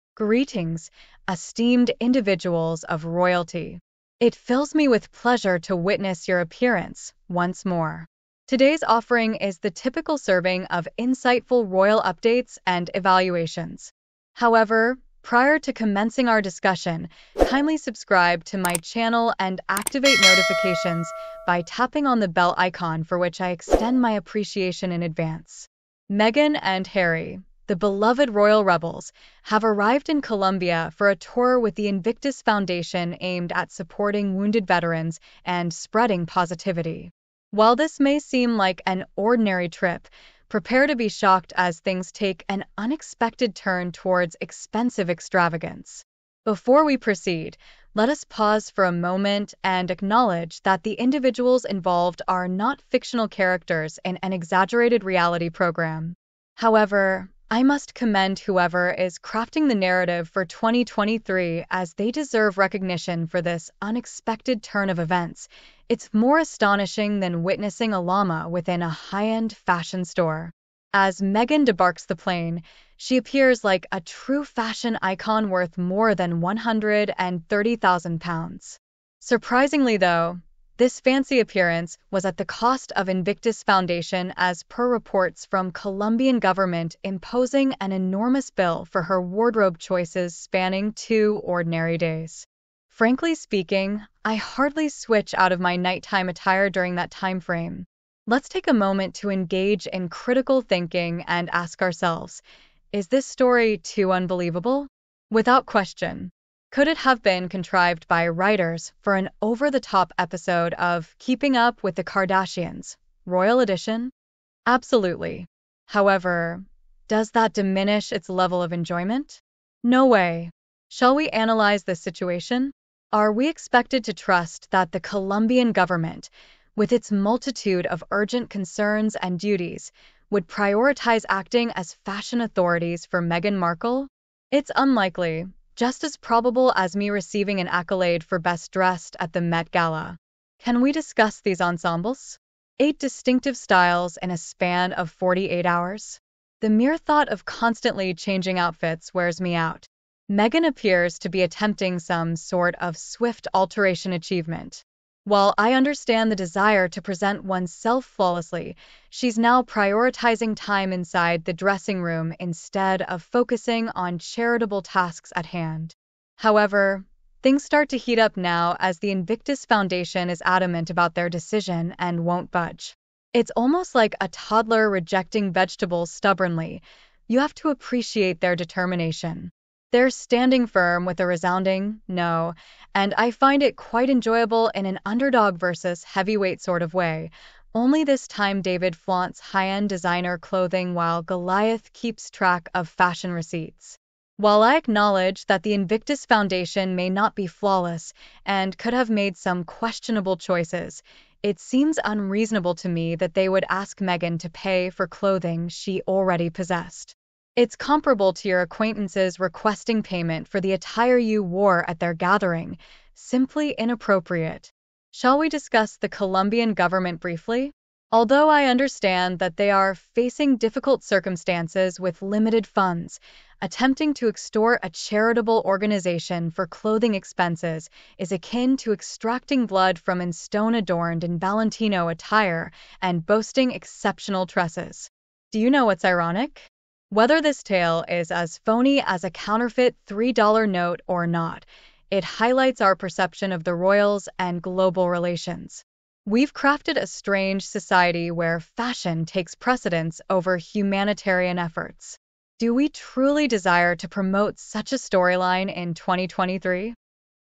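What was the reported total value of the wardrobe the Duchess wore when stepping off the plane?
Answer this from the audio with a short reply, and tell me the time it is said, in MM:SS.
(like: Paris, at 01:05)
£130,000, at 01:16.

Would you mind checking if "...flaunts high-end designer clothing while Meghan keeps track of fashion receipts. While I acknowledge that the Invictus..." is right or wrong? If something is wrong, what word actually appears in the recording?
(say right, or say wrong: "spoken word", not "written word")
wrong: "Goliath", not "Meghan".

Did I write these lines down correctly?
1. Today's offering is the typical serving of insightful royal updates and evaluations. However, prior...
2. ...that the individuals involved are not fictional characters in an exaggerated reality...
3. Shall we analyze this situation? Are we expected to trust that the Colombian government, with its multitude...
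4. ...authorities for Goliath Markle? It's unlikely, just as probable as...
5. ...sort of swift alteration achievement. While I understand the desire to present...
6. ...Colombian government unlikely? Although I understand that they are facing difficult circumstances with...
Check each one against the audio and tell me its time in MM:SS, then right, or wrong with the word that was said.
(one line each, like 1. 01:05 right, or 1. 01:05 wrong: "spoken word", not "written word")
1. 00:08 right
2. 00:50 right
3. 02:00 right
4. 02:12 wrong: "Meghan", not "Goliath"
5. 02:32 right
6. 03:36 wrong: "briefly", not "unlikely".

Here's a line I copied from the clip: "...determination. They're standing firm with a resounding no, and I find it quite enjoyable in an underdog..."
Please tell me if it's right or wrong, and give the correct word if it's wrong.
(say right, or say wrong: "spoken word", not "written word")
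right.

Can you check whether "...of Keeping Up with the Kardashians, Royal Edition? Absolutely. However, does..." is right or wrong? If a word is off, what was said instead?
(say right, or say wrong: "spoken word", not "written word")
right.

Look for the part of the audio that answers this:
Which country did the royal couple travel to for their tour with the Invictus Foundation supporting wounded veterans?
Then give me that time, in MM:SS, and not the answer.
00:30.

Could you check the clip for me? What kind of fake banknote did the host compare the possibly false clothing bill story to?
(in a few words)
A counterfeit $3 note.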